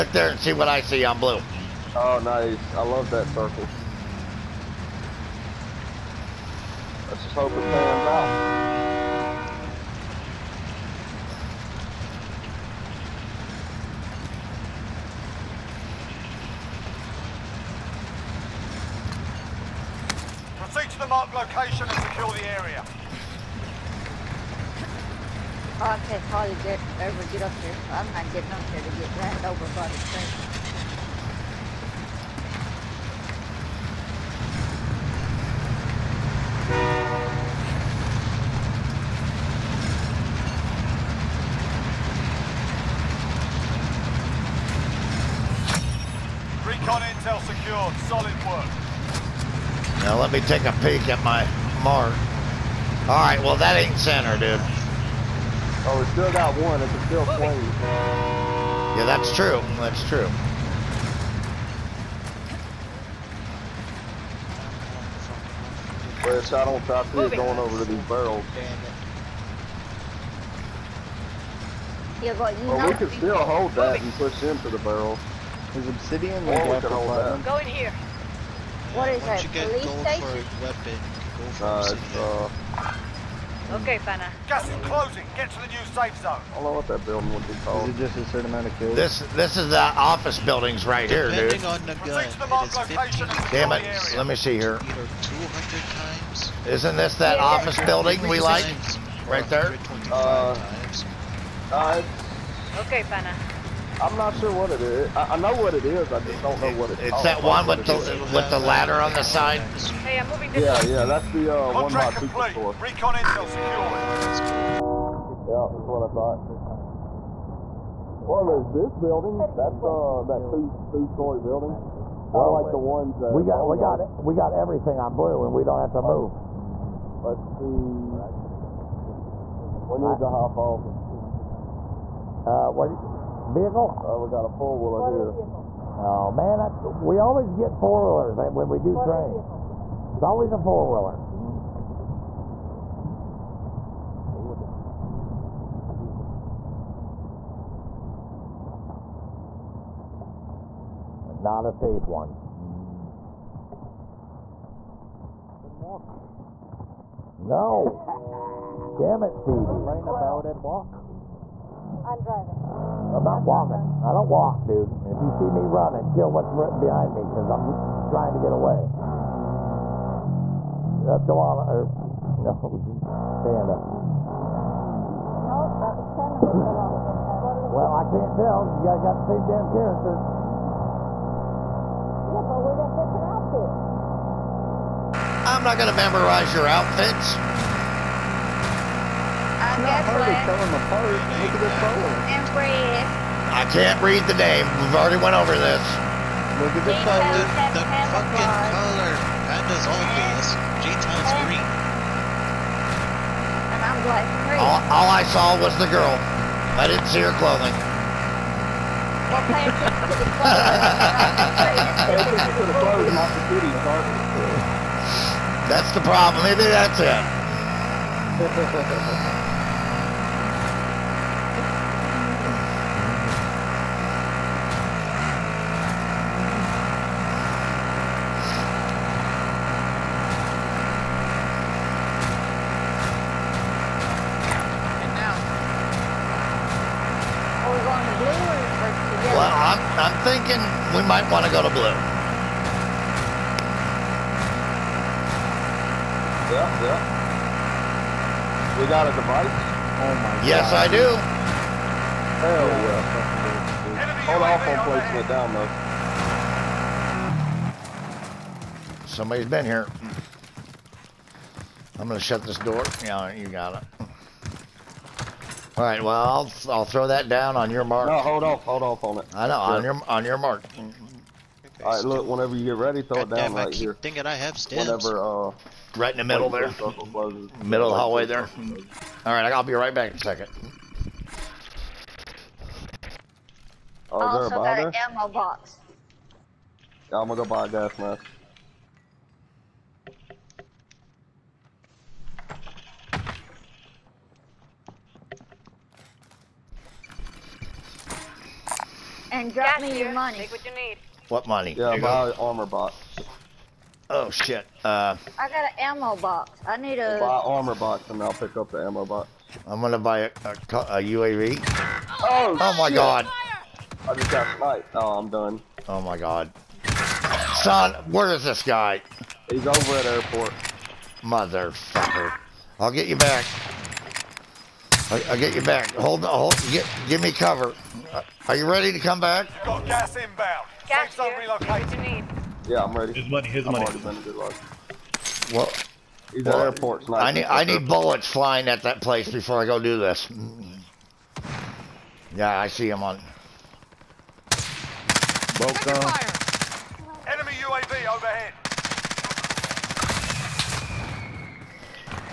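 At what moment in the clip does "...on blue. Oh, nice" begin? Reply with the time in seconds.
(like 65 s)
1 s.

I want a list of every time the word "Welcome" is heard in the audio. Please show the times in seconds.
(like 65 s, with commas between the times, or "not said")
345 s.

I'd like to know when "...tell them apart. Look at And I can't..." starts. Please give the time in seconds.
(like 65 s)
190 s.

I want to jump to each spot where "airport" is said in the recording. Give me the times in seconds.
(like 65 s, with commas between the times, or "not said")
320 s, 336 s.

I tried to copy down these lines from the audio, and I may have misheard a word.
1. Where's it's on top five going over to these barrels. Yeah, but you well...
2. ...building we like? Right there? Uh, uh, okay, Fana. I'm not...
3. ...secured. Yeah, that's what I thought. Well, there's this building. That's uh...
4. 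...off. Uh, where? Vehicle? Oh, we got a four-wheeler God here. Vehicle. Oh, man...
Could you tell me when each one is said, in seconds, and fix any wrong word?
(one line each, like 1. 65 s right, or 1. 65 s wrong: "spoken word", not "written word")
1. 66 s wrong: "three", not "five"
2. 97 s right
3. 114 s right
4. 130 s wrong: "Motor", not "God".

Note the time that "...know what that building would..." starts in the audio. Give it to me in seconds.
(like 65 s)
86 s.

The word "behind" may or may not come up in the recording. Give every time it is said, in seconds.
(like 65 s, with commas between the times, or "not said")
166 s.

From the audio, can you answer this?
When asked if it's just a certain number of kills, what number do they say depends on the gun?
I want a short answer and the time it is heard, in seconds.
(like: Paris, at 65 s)
15, at 93 s.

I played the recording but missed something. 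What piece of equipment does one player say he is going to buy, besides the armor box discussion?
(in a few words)
UAV.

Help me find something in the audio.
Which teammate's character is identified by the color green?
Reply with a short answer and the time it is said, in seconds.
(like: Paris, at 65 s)
G-Town, at 200 s.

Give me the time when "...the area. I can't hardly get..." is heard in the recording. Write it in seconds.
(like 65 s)
22 s.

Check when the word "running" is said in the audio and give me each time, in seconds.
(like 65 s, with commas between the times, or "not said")
165 s.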